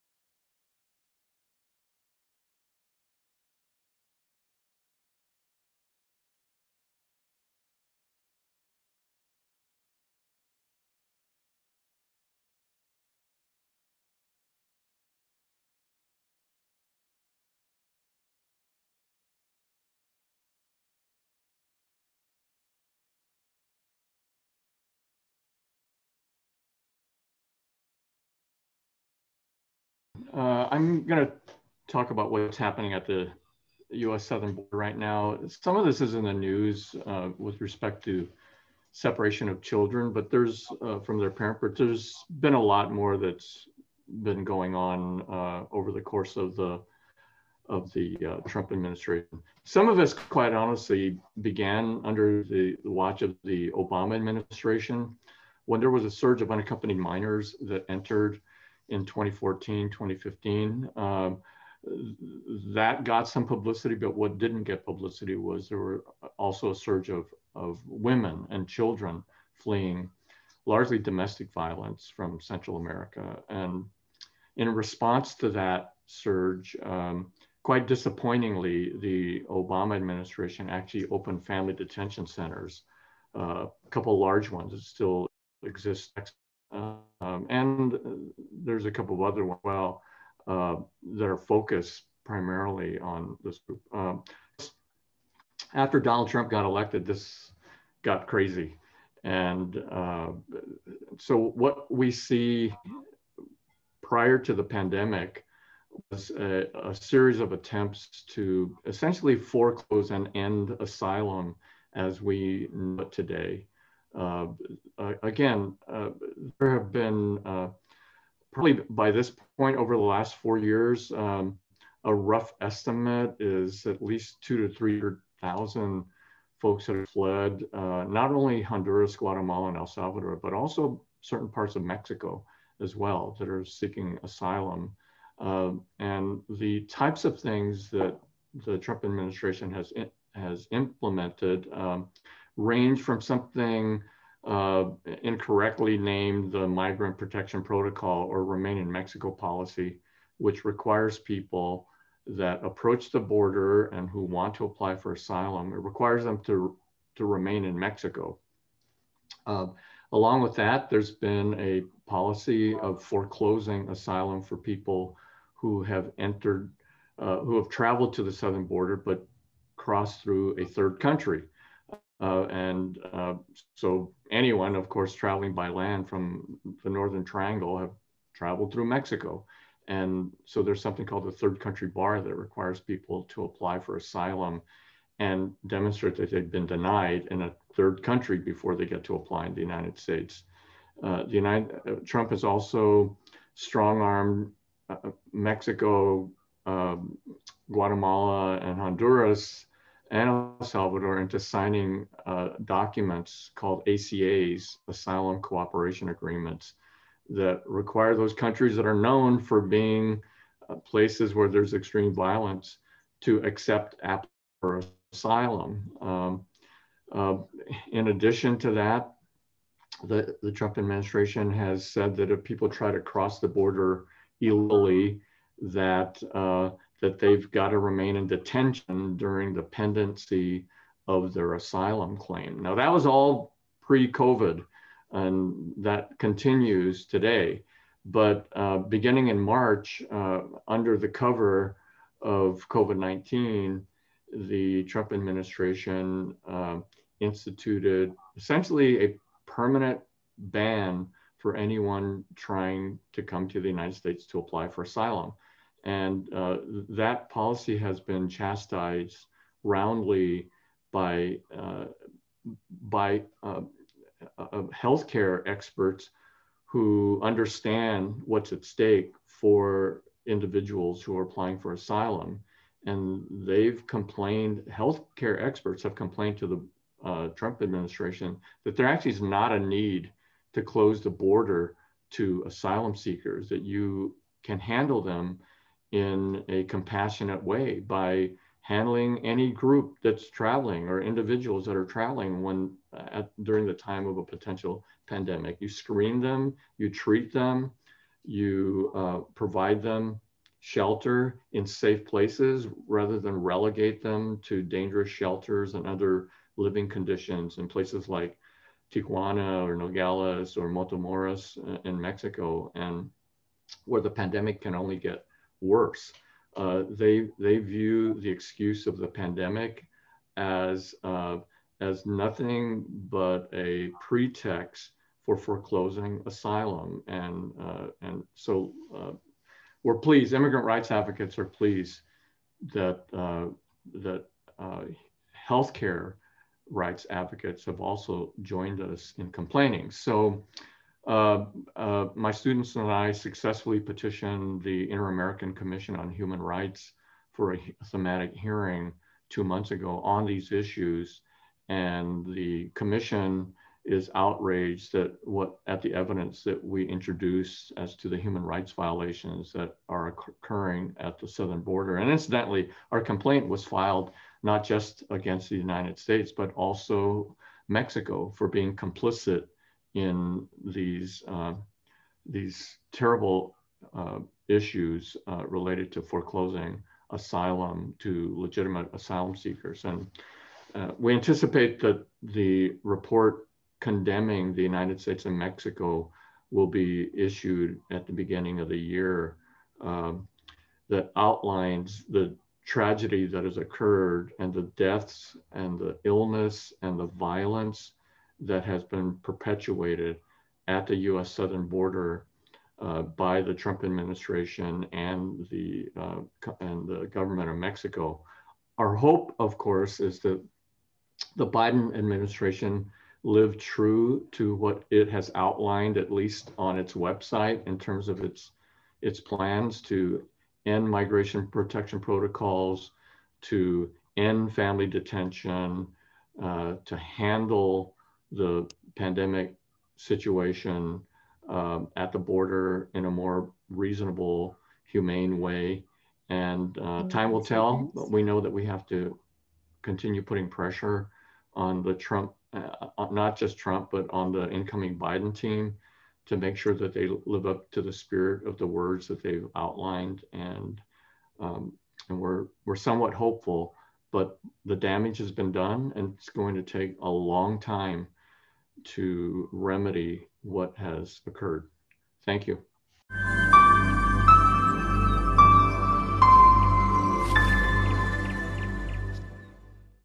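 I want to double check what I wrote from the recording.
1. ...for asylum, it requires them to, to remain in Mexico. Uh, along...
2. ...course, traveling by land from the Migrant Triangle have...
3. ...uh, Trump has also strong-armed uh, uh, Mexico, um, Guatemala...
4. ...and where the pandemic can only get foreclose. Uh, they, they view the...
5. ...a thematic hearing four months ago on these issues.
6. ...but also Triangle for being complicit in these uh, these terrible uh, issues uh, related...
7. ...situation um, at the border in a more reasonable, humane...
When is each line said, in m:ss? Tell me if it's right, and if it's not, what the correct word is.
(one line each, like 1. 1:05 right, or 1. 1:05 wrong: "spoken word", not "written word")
1. 2:34 right
2. 2:54 wrong: "Northern", not "Migrant"
3. 3:11 right
4. 5:12 wrong: "worse", not "foreclose"
5. 5:47 wrong: "two", not "four"
6. 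6:06 wrong: "Mexico", not "Triangle"
7. 7:09 right.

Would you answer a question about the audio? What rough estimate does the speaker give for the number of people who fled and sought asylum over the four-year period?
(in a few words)
200,000 to 300,000.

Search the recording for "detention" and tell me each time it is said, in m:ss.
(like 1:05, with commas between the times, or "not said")
1:21, 3:48, 7:04.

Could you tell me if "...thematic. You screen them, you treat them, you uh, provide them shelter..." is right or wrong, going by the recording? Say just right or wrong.
wrong.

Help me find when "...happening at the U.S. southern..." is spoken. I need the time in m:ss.
0:32.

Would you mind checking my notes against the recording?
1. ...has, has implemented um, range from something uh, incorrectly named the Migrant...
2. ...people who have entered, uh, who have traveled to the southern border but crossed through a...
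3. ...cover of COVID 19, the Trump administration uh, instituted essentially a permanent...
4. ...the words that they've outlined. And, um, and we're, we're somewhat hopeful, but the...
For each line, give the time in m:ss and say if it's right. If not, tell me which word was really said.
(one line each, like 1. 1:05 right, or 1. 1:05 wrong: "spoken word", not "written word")
1. 2:19 right
2. 2:44 right
3. 4:01 right
4. 7:28 right.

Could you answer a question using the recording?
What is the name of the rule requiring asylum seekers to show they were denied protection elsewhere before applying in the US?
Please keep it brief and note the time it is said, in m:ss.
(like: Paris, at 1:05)
third country bar, at 3:01.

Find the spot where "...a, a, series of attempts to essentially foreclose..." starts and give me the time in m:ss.
1:46.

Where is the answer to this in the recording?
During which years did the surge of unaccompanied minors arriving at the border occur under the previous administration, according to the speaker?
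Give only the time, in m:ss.
0:59.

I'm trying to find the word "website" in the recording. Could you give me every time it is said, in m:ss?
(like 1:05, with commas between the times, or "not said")
6:56.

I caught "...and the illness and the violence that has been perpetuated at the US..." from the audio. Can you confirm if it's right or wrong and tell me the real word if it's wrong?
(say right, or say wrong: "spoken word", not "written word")
right.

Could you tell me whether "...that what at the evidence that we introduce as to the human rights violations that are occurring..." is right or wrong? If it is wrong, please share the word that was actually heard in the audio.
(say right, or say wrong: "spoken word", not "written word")
right.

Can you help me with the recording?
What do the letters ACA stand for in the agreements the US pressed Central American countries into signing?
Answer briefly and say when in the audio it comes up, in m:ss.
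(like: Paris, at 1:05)
Asylum Cooperation Agreements, at 3:24.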